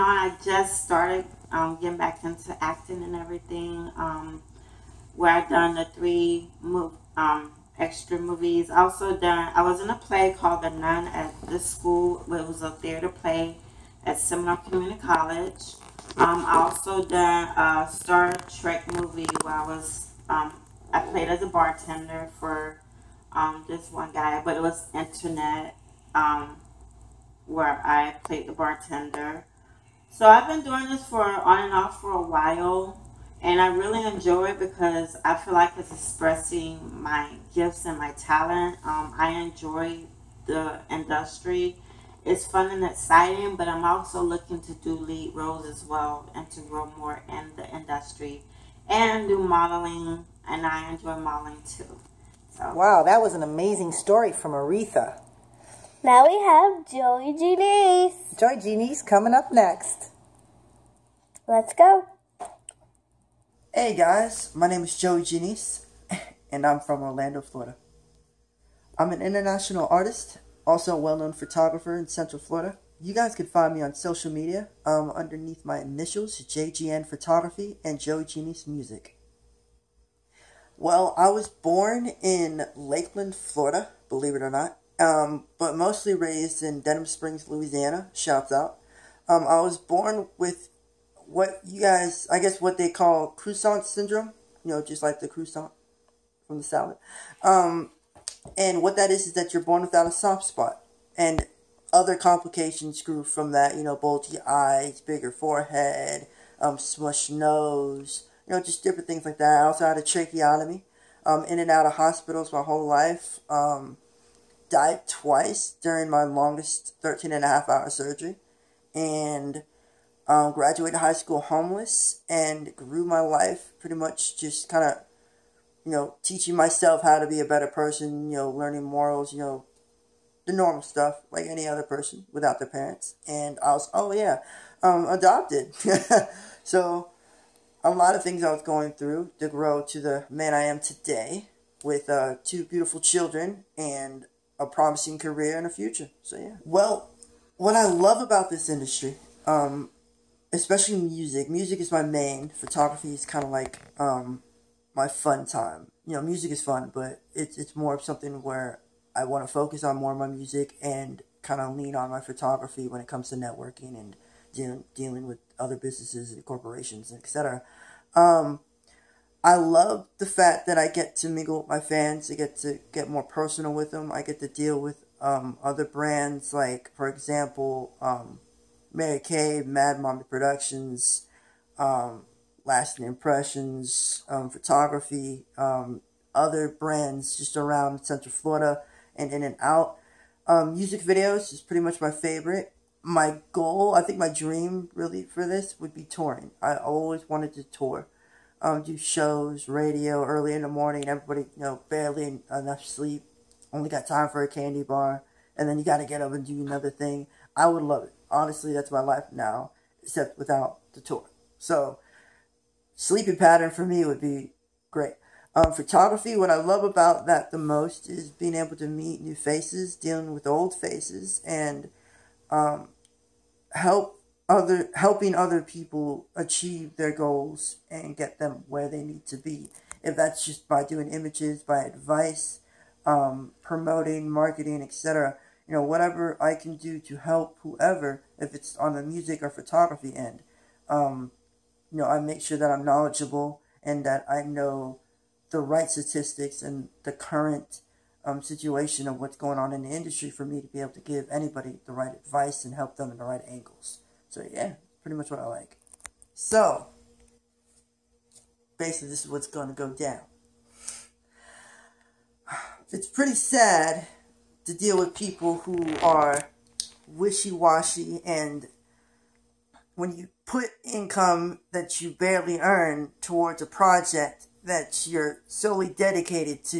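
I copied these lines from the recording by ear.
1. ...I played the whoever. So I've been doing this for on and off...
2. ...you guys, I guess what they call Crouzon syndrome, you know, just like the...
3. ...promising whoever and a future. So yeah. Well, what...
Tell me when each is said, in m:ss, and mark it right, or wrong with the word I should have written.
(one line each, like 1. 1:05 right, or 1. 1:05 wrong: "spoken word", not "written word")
1. 0:27 wrong: "bartender", not "whoever"
2. 1:31 right
3. 2:24 wrong: "career", not "whoever".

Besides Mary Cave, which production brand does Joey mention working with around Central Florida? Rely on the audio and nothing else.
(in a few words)
Mad Mommy Productions.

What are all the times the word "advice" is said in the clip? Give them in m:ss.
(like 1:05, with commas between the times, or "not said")
3:51, 4:12.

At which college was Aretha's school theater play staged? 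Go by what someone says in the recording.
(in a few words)
Seminole Community College.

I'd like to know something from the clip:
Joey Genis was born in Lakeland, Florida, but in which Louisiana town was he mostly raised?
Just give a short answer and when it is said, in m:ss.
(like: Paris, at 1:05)
Denham Springs, at 1:26.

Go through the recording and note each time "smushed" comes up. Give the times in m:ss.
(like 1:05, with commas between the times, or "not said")
1:46.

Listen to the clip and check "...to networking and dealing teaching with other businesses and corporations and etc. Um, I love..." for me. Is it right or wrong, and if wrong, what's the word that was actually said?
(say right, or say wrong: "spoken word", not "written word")
wrong: "dealing", not "teaching".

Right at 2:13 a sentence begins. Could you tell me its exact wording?
And I was, oh yeah, um, adopted.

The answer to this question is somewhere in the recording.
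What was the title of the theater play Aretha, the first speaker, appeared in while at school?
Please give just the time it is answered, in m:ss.
0:10.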